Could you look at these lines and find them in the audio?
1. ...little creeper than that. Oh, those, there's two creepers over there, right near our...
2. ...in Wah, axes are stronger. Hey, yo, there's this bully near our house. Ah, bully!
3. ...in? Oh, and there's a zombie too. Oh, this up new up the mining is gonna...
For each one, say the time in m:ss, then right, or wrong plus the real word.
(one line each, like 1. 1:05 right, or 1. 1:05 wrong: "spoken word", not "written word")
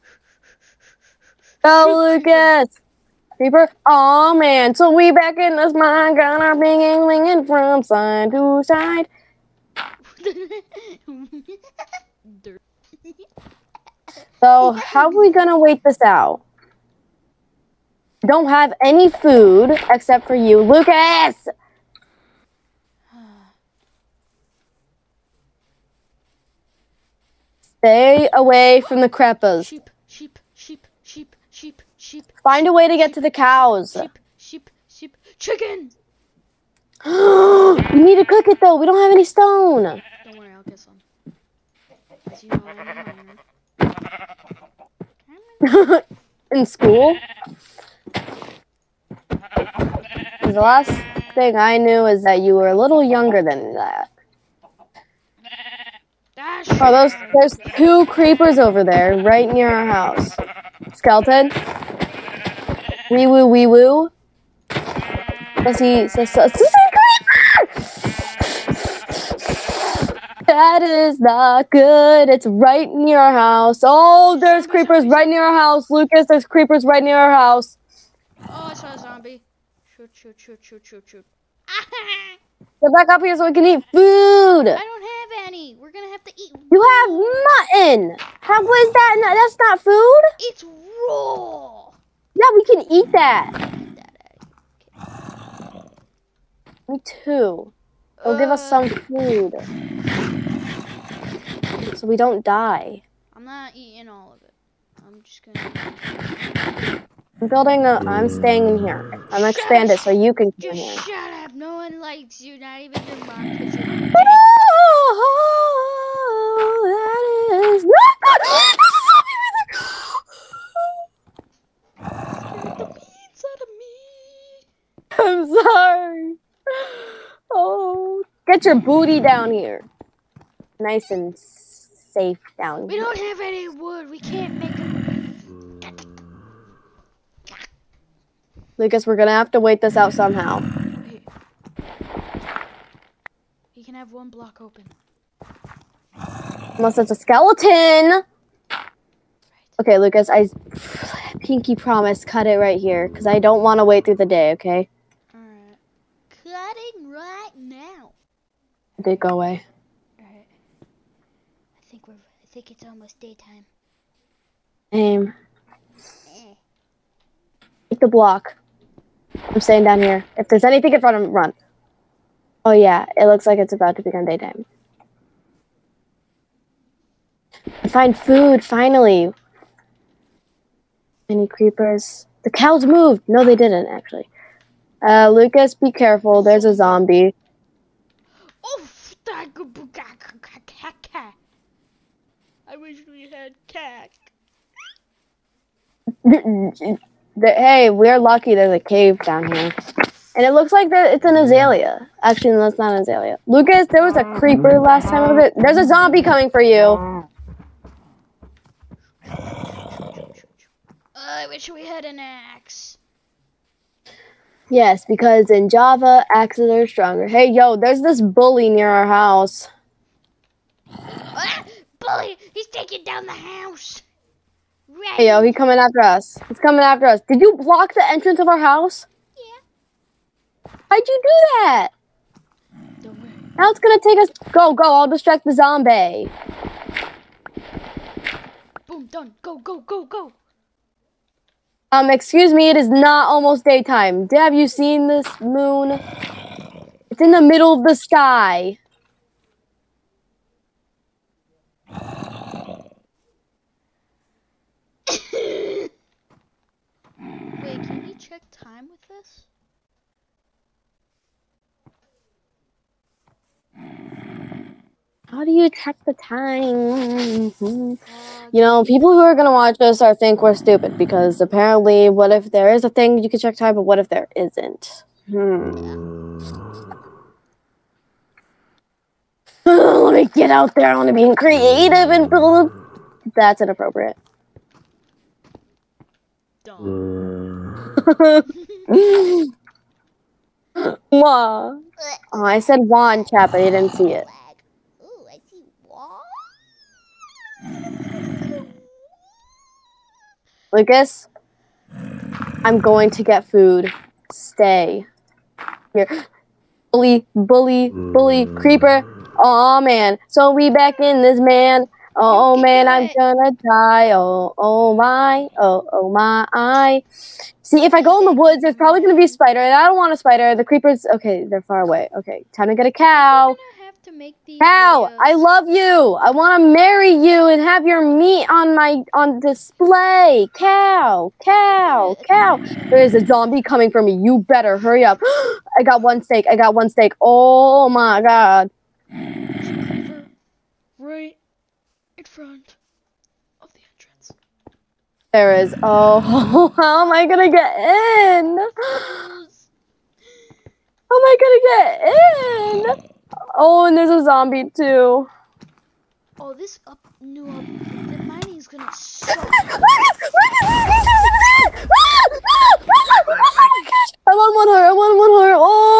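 1. 0:52 wrong: "younger", not "creeper"
2. 3:35 wrong: "Java", not "Wah"
3. 5:53 right.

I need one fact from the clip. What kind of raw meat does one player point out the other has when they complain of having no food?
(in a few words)
mutton.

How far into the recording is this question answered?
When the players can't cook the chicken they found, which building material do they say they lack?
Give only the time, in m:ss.
0:38.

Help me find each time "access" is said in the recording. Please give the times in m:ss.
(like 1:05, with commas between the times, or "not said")
not said.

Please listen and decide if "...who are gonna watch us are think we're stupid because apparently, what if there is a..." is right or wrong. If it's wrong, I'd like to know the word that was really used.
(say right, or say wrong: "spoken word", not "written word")
right.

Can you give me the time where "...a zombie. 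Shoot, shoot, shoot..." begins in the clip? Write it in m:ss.
1:18.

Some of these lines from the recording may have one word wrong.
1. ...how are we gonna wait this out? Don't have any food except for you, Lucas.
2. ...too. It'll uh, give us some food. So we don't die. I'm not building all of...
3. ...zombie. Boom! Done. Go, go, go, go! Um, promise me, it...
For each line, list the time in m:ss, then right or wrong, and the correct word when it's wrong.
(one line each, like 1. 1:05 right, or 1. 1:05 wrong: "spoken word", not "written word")
1. 0:14 right
2. 1:37 wrong: "eating", not "building"
3. 3:55 wrong: "excuse", not "promise".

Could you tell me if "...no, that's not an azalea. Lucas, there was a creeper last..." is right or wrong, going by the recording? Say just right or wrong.
right.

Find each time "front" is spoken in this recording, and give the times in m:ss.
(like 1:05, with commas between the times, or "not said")
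2:51, 5:42.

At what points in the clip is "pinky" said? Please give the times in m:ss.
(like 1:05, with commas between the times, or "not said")
2:31.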